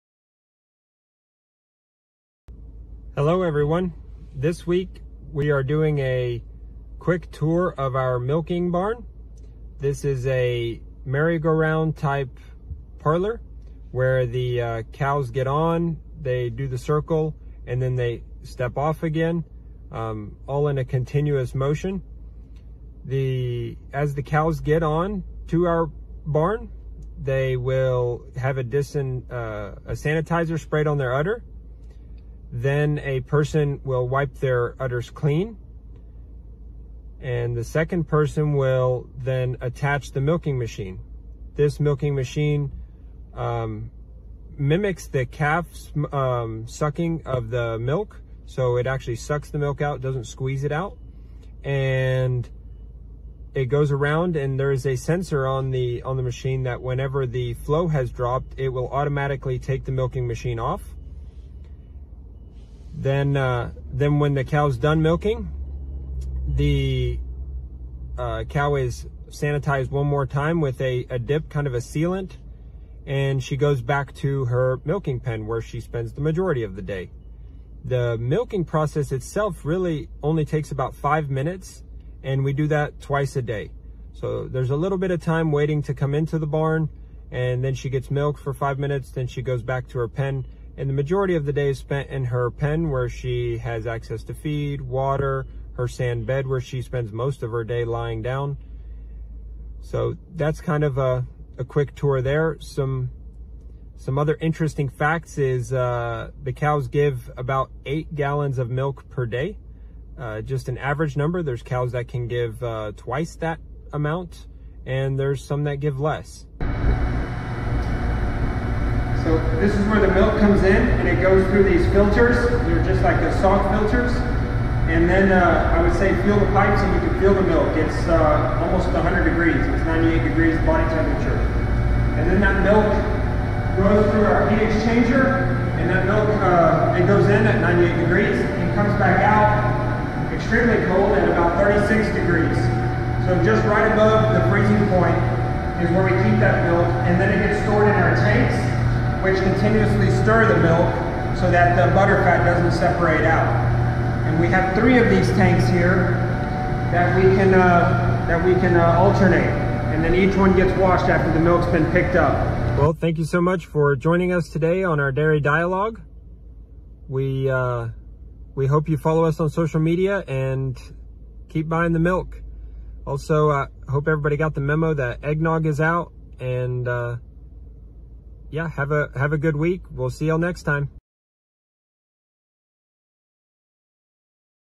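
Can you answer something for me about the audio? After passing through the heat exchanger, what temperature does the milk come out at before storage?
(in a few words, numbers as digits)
36 degrees.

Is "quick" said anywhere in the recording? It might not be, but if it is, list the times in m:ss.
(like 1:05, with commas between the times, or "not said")
0:06, 1:41.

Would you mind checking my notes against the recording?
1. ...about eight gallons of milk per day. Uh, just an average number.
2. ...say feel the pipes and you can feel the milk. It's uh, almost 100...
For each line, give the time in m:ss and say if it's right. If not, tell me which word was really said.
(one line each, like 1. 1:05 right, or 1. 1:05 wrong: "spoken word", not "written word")
1. 1:47 right
2. 2:05 right.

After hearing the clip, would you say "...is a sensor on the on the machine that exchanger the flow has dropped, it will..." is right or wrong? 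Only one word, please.
wrong.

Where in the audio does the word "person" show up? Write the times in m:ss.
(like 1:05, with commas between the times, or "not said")
0:33, 0:38.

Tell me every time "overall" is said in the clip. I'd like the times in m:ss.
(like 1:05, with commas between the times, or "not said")
not said.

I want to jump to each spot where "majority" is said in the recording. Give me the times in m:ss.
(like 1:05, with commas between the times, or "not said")
1:16, 1:30.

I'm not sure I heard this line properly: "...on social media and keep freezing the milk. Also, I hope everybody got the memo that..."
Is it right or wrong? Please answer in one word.
wrong.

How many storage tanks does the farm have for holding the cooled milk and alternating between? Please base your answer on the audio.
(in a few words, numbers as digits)
3.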